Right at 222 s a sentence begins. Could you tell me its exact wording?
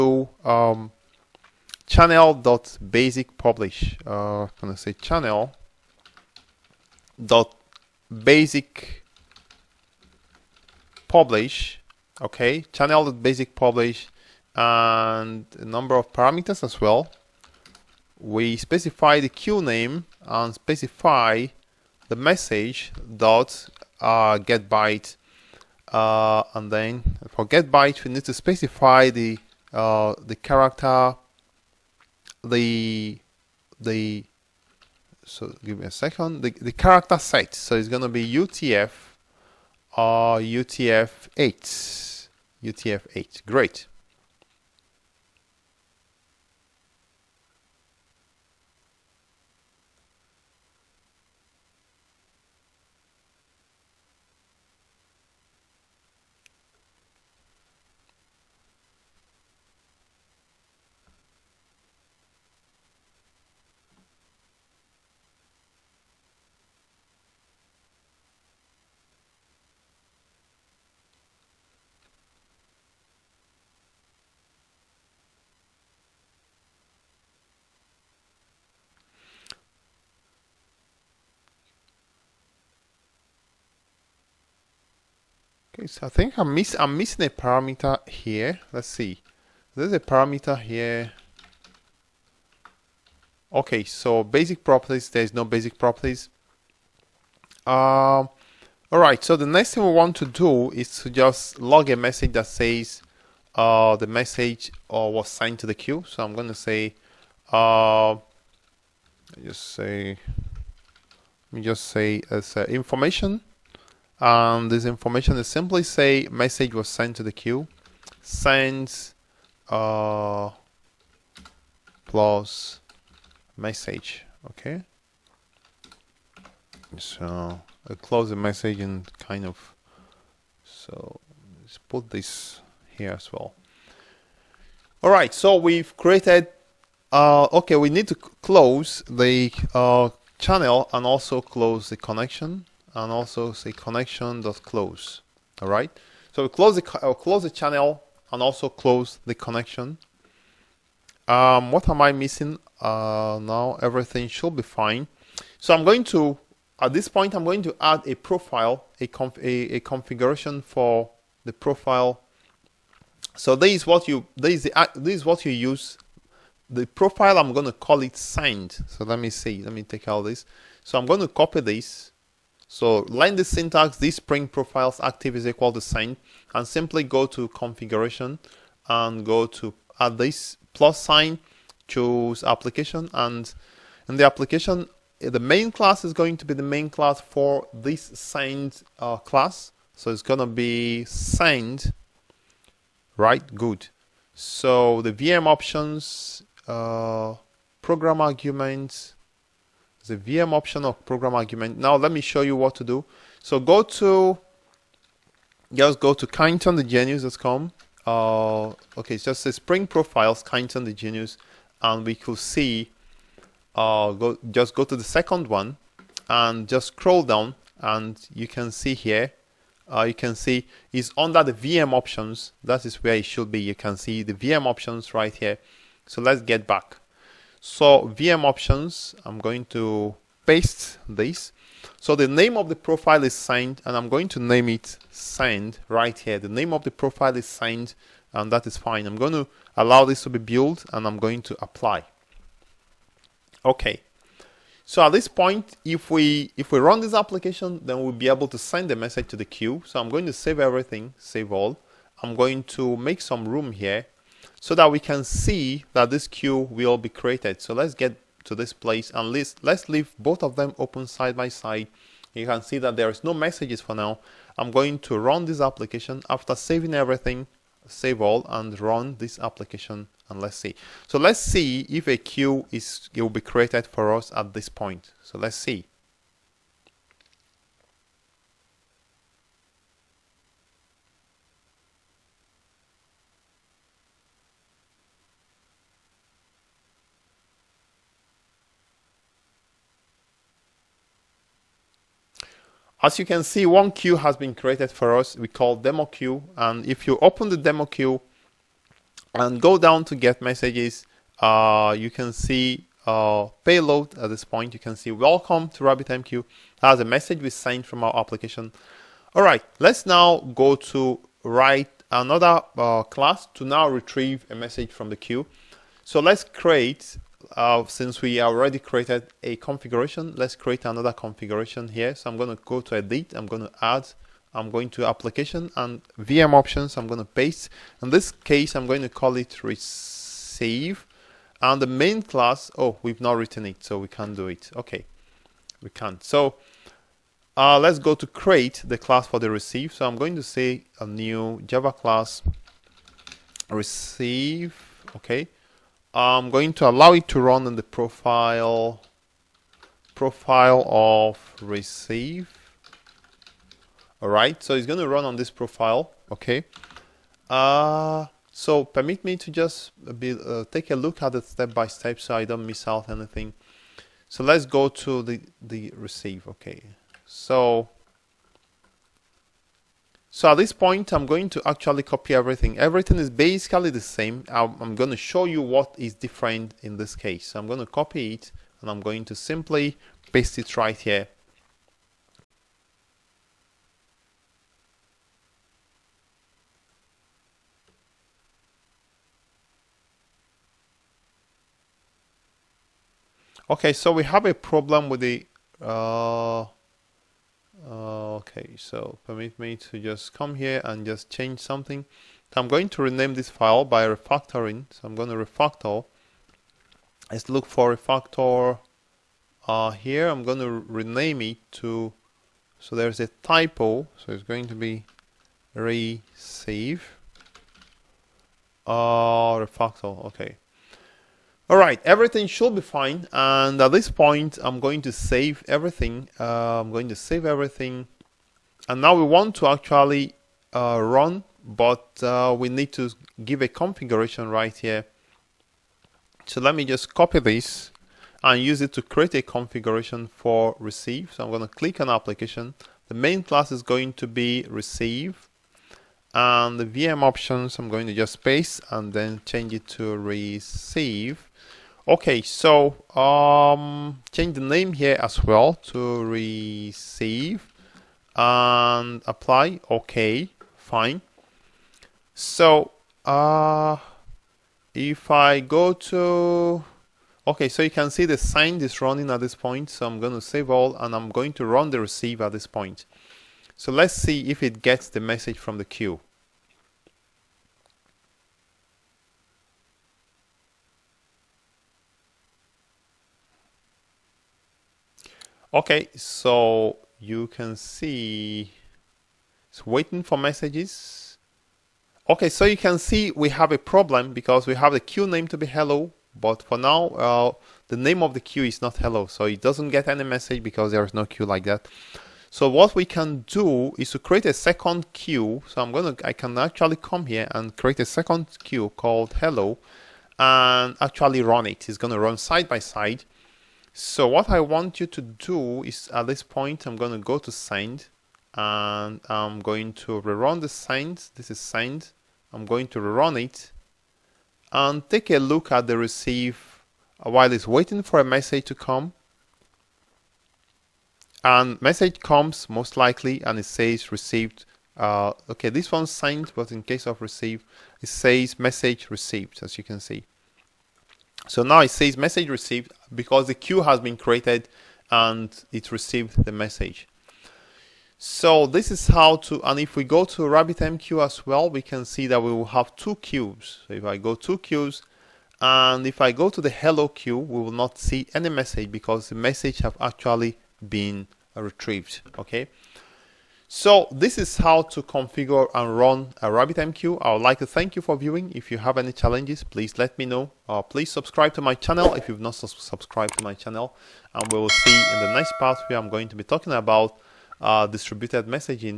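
That is where it should be.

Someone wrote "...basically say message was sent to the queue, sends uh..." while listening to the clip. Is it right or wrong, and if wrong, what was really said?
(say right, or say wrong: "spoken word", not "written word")
wrong: "simply", not "basically".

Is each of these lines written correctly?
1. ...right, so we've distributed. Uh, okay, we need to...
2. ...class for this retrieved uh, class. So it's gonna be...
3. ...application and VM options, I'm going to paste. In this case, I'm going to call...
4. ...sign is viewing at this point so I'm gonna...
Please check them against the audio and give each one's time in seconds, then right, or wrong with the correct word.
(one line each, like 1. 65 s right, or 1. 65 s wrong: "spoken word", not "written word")
1. 135 s wrong: "created", not "distributed"
2. 186 s wrong: "signed", not "retrieved"
3. 325 s right
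4. 468 s wrong: "running", not "viewing".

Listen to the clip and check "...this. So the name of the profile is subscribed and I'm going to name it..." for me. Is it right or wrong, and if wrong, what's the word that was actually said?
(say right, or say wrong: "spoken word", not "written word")
wrong: "signed", not "subscribed".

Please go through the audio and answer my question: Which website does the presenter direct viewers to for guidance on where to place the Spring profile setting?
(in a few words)
kindsonthegenius.com.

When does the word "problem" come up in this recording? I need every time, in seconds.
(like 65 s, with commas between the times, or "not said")
394 s, 493 s.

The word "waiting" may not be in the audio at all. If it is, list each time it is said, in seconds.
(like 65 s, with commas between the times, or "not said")
489 s, 527 s.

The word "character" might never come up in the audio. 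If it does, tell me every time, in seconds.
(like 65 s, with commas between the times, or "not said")
30 s, 36 s.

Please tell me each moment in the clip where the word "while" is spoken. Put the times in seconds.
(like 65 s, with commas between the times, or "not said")
527 s.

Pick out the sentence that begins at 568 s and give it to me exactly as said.
If you have any challenges, please let me know.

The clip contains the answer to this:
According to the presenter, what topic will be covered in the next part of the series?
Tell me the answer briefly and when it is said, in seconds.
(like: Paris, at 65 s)
distributed messaging, at 577 s.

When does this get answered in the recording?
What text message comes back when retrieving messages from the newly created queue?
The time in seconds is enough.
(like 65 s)
305 s.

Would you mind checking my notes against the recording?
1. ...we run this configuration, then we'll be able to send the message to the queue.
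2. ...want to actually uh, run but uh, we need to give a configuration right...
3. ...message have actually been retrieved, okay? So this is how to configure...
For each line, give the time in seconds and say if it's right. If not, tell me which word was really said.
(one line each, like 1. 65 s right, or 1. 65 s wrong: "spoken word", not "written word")
1. 246 s wrong: "application", not "configuration"
2. 429 s right
3. 559 s right.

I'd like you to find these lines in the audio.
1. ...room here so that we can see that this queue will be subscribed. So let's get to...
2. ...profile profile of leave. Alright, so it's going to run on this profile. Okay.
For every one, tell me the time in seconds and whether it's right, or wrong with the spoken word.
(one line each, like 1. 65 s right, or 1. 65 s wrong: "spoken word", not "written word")
1. 253 s wrong: "created", not "subscribed"
2. 347 s wrong: "receive", not "leave".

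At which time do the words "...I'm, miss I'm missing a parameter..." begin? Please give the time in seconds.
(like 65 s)
86 s.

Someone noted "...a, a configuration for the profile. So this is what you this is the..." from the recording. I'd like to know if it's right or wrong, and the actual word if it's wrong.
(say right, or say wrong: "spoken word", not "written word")
right.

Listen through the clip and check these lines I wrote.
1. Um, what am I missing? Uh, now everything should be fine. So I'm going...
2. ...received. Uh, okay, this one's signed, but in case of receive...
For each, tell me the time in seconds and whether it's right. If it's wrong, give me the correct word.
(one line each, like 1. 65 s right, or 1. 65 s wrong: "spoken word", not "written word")
1. 151 s right
2. 534 s right.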